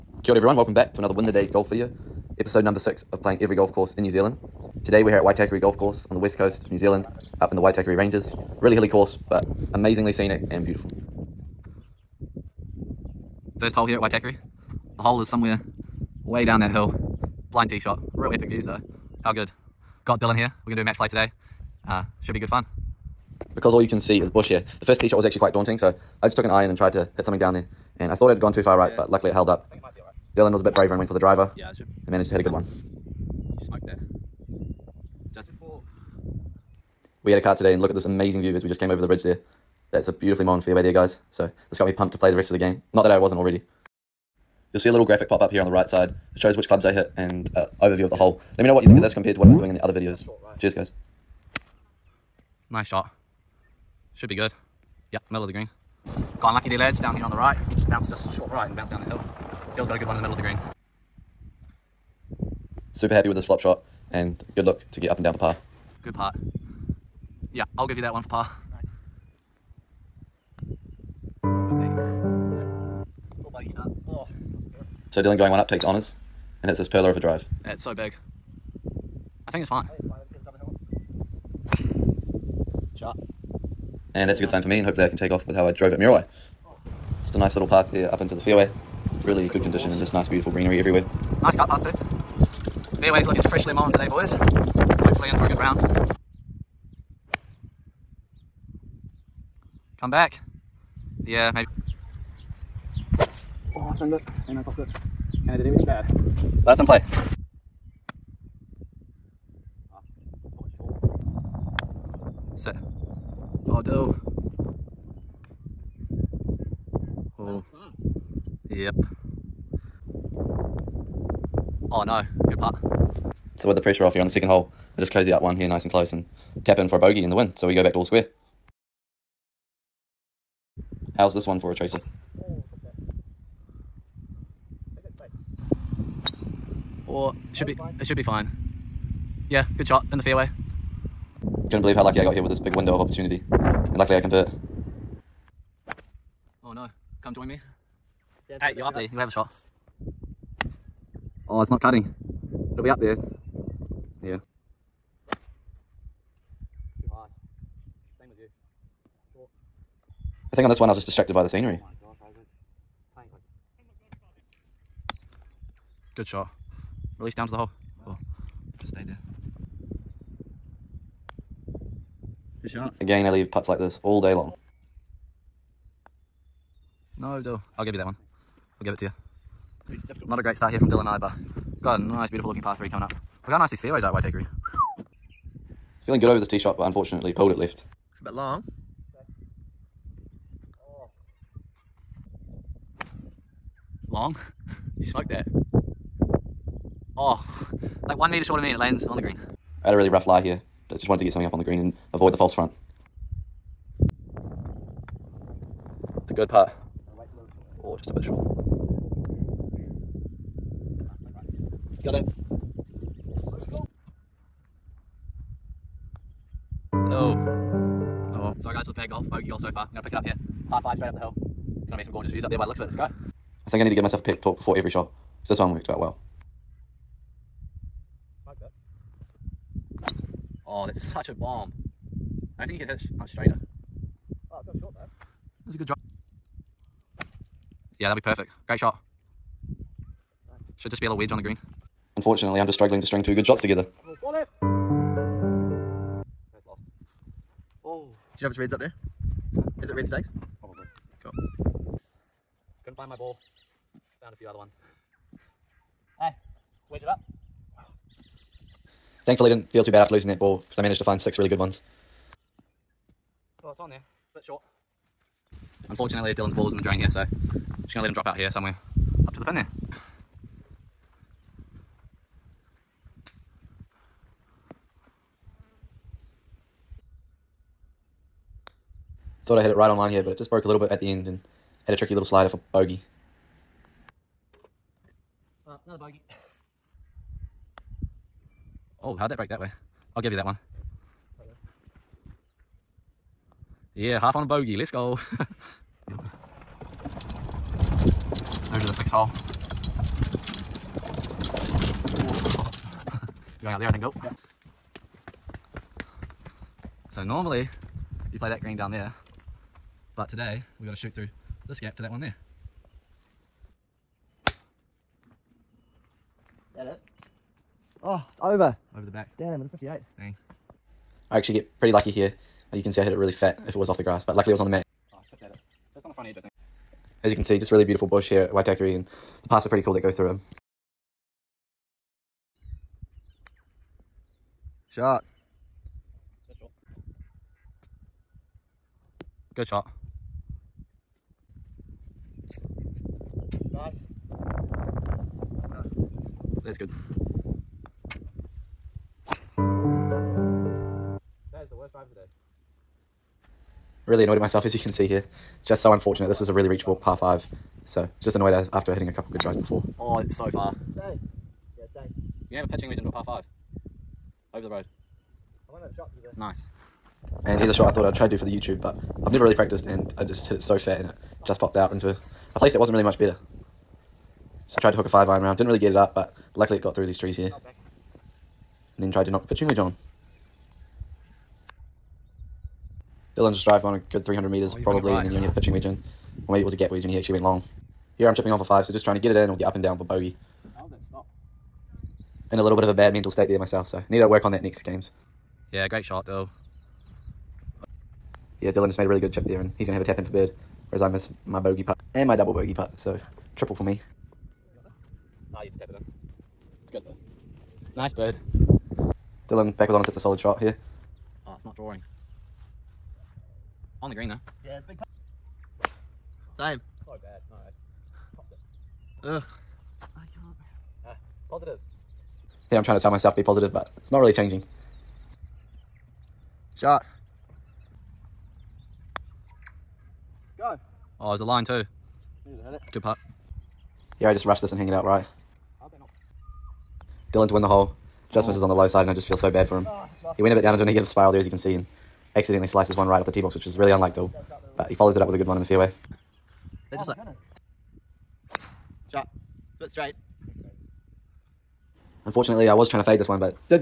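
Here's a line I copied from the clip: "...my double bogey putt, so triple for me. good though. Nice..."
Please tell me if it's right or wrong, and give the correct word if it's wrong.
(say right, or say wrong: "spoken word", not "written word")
right.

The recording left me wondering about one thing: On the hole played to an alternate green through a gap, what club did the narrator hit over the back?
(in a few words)
58.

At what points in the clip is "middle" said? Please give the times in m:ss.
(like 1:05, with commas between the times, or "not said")
0:55, 1:00.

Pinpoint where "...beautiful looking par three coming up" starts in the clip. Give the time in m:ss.
3:02.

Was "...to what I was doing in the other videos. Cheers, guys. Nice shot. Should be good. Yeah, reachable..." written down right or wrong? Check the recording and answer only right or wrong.
wrong.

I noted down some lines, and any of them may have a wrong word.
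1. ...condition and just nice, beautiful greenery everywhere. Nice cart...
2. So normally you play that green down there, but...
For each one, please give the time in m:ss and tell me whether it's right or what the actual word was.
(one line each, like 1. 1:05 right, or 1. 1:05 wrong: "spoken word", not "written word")
1. 1:29 right
2. 5:07 right.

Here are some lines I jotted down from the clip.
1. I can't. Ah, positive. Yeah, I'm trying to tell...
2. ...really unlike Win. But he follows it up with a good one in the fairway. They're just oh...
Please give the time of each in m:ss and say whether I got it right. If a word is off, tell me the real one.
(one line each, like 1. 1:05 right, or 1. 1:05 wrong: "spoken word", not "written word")
1. 7:00 right
2. 7:23 wrong: "Dill", not "Win".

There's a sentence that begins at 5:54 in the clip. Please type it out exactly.
Really annoyed at myself as you can see here just so unfortunate.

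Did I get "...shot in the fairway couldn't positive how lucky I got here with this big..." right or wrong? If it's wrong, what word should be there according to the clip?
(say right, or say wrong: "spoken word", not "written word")
wrong: "believe", not "positive".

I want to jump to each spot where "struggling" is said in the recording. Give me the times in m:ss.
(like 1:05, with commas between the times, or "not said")
4:02.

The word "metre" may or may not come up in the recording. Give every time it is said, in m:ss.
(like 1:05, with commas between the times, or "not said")
3:18, 6:24.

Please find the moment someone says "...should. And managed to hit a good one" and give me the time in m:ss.
0:31.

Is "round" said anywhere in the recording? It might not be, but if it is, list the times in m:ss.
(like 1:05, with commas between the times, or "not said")
1:35, 6:15.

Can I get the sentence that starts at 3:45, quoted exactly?
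Because this one worked out well.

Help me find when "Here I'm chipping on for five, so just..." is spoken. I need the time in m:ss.
6:28.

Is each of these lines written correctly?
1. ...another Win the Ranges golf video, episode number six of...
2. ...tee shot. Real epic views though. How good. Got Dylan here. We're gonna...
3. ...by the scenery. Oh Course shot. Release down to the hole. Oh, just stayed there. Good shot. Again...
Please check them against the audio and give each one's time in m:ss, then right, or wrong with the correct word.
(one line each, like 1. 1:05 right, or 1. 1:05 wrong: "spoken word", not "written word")
1. 0:01 wrong: "Day", not "Ranges"
2. 0:17 right
3. 2:41 wrong: "Good", not "Course".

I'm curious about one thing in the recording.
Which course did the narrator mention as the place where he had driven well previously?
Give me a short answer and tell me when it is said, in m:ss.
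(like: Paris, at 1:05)
Muriwai, at 1:25.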